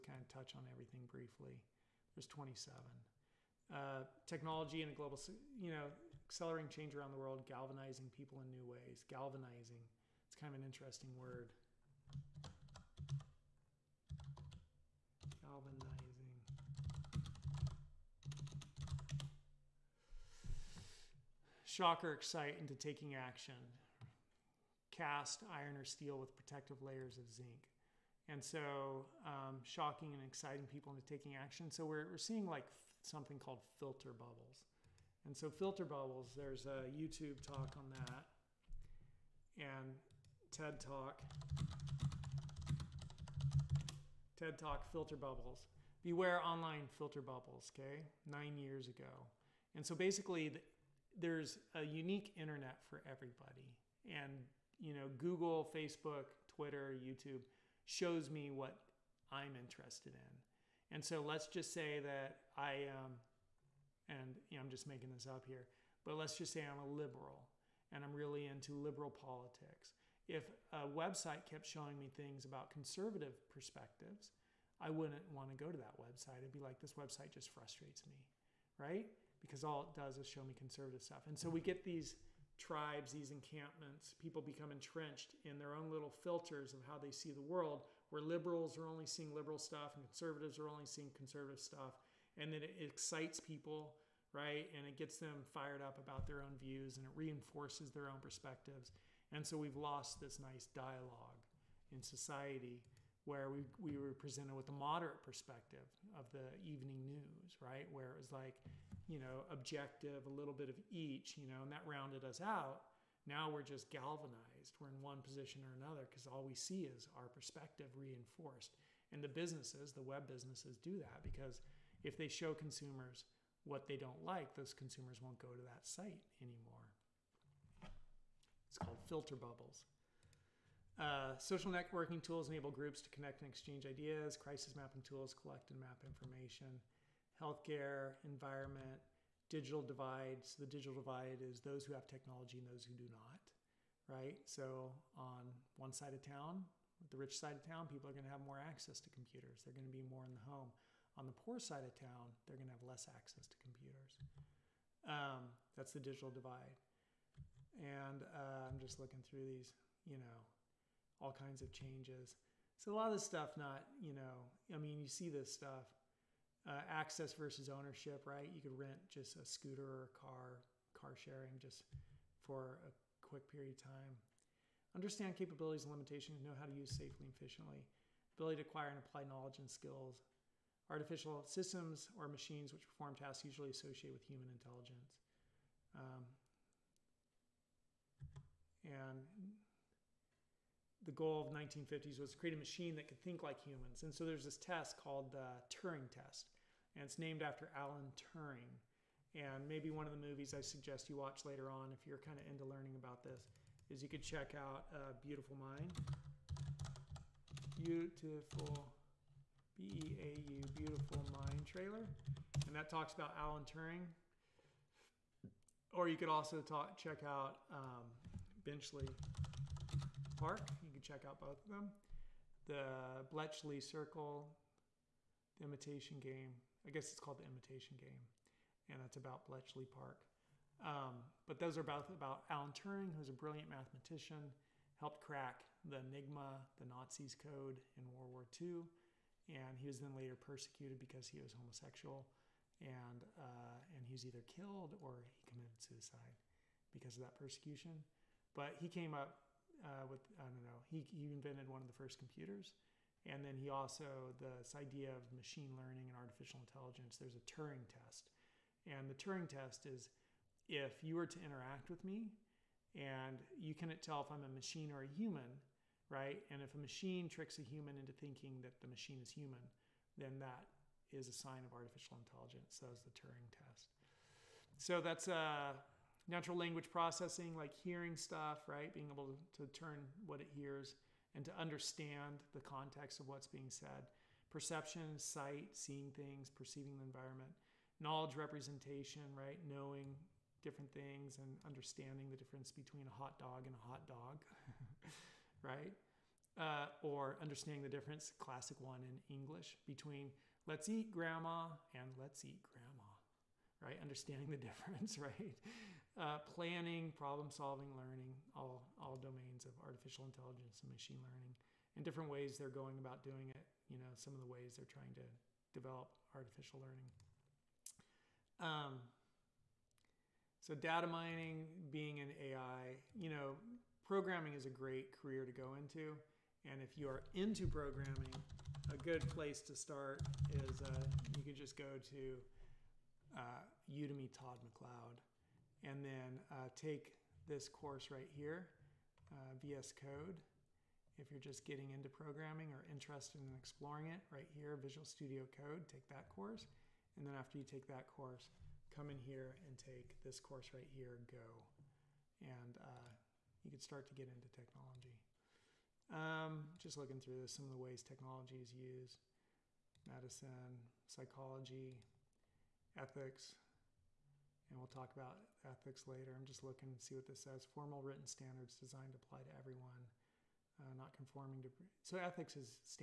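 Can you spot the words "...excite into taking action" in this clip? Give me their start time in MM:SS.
00:22.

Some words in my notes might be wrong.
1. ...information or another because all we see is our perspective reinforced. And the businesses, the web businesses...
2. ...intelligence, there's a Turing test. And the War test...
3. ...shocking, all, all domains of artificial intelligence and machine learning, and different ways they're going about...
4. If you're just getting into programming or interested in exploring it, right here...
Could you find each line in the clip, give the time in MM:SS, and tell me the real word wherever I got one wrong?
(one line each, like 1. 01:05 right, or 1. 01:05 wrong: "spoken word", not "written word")
1. 01:55 wrong: "position", not "information"
2. 04:16 wrong: "Turing", not "War"
3. 05:07 wrong: "learning", not "shocking"
4. 05:41 right.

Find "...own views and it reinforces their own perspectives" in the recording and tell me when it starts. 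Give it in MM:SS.
01:36.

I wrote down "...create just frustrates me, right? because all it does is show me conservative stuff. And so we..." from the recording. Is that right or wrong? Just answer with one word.
wrong.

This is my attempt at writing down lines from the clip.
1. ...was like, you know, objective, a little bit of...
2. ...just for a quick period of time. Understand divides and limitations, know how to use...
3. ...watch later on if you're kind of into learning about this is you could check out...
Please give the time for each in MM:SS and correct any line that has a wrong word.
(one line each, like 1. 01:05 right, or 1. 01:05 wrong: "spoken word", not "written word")
1. 01:48 right
2. 02:51 wrong: "capabilities", not "divides"
3. 03:21 right.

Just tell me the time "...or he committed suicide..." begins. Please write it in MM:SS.
04:05.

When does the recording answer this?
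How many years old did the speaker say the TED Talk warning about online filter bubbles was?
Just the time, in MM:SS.
00:48.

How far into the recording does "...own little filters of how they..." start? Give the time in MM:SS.
01:25.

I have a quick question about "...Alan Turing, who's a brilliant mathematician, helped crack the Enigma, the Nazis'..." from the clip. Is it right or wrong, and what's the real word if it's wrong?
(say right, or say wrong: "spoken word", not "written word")
right.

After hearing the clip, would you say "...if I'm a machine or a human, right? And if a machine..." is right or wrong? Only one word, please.
right.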